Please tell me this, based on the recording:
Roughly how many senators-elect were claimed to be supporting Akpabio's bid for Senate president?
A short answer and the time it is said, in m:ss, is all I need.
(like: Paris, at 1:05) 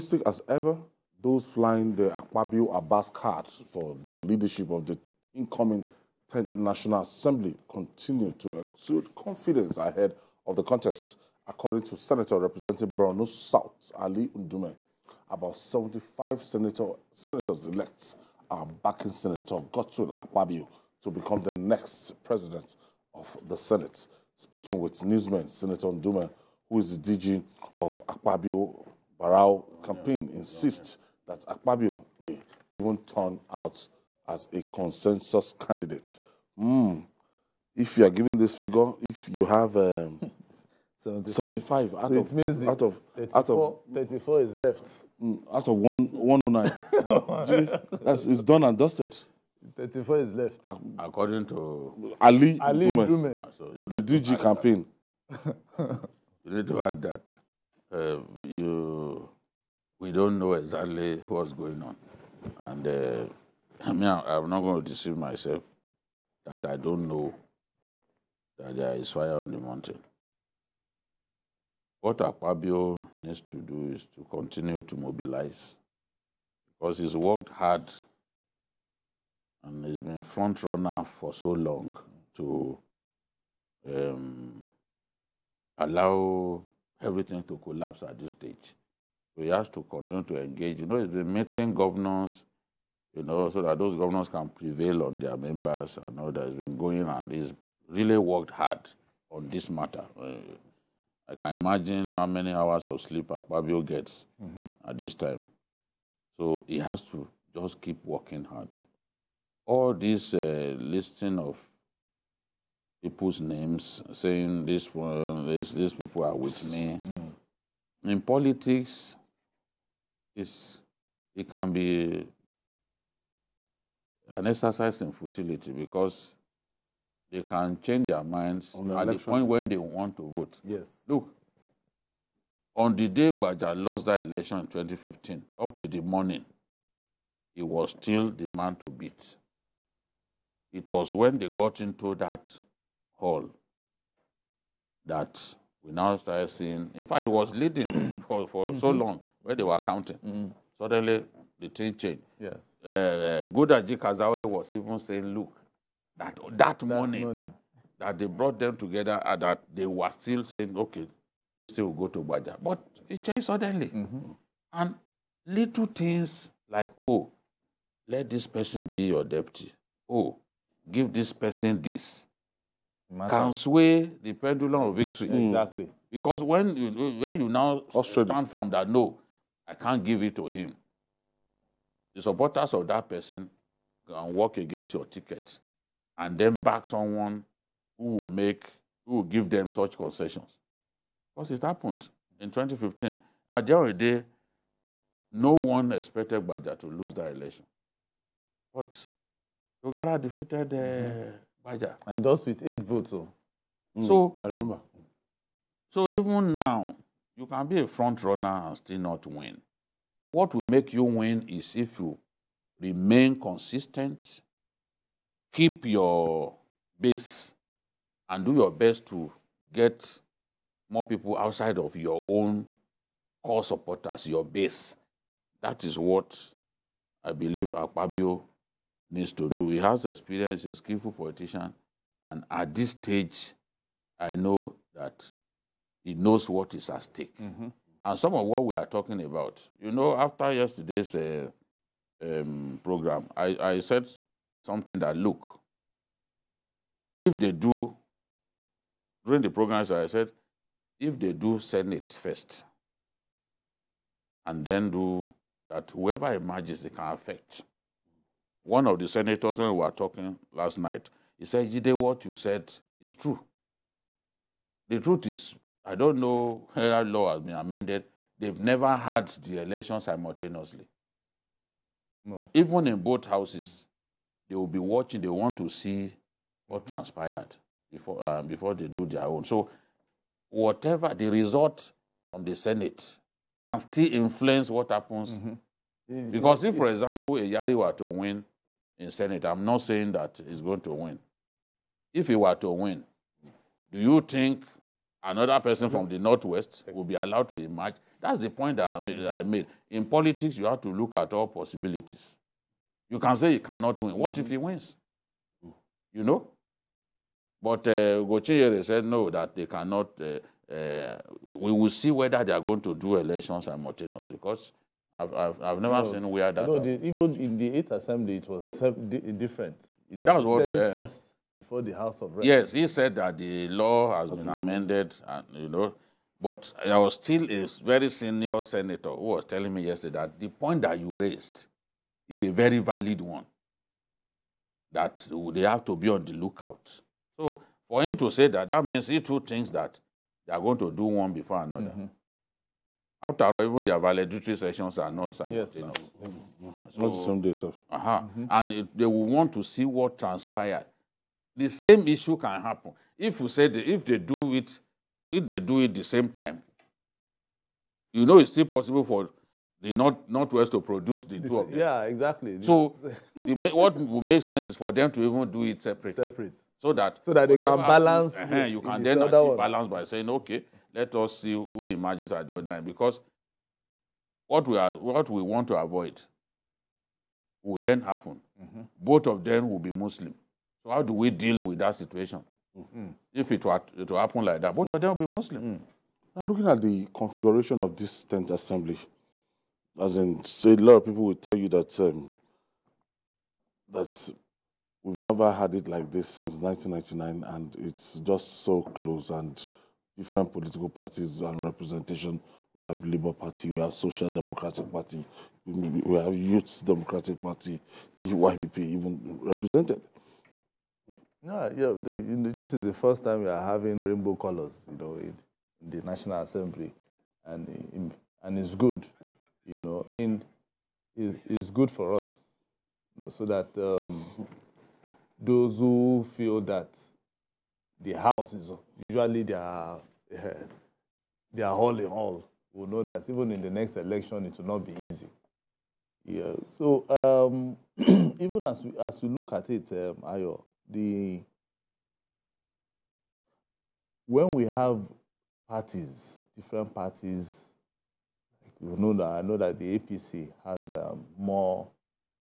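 75, at 0:15.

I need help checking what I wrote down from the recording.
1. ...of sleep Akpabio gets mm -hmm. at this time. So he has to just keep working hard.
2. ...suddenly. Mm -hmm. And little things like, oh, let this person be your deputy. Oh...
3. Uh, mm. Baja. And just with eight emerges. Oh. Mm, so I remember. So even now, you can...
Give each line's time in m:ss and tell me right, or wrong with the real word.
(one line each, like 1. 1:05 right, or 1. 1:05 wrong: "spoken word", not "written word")
1. 1:42 right
2. 2:43 right
3. 3:20 wrong: "votes", not "emerges".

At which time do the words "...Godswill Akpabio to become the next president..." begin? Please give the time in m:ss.
0:19.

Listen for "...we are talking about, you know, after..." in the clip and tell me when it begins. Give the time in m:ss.
3:58.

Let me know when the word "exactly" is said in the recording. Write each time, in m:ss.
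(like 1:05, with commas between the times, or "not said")
1:00, 2:55, 6:02.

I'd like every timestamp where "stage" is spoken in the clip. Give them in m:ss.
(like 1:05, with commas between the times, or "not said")
1:28, 3:52.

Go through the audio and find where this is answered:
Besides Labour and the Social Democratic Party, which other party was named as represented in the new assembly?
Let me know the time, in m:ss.
6:46.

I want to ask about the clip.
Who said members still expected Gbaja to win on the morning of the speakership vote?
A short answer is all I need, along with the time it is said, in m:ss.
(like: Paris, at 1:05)
Gudaji Kazaure, at 2:33.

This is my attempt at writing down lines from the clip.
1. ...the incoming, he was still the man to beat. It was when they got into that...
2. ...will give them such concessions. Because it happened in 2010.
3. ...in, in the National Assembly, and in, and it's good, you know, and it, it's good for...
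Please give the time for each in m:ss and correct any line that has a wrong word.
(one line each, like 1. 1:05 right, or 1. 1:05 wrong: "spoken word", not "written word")
1. 2:15 wrong: "morning", not "incoming"
2. 3:09 wrong: "2015", not "2010"
3. 6:55 right.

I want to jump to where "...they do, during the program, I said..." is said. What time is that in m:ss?
4:07.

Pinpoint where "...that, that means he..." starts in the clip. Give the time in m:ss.
5:38.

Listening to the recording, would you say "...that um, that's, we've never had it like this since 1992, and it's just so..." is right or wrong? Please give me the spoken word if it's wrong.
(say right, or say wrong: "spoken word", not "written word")
wrong: "1999", not "1992".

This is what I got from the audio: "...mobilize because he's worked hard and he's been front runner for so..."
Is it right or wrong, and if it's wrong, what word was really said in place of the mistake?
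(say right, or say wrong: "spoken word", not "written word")
right.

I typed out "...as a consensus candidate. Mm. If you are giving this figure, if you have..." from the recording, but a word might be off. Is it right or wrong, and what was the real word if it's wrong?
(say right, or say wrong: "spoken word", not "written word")
right.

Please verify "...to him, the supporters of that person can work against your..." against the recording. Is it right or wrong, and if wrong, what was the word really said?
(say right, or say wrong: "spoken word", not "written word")
right.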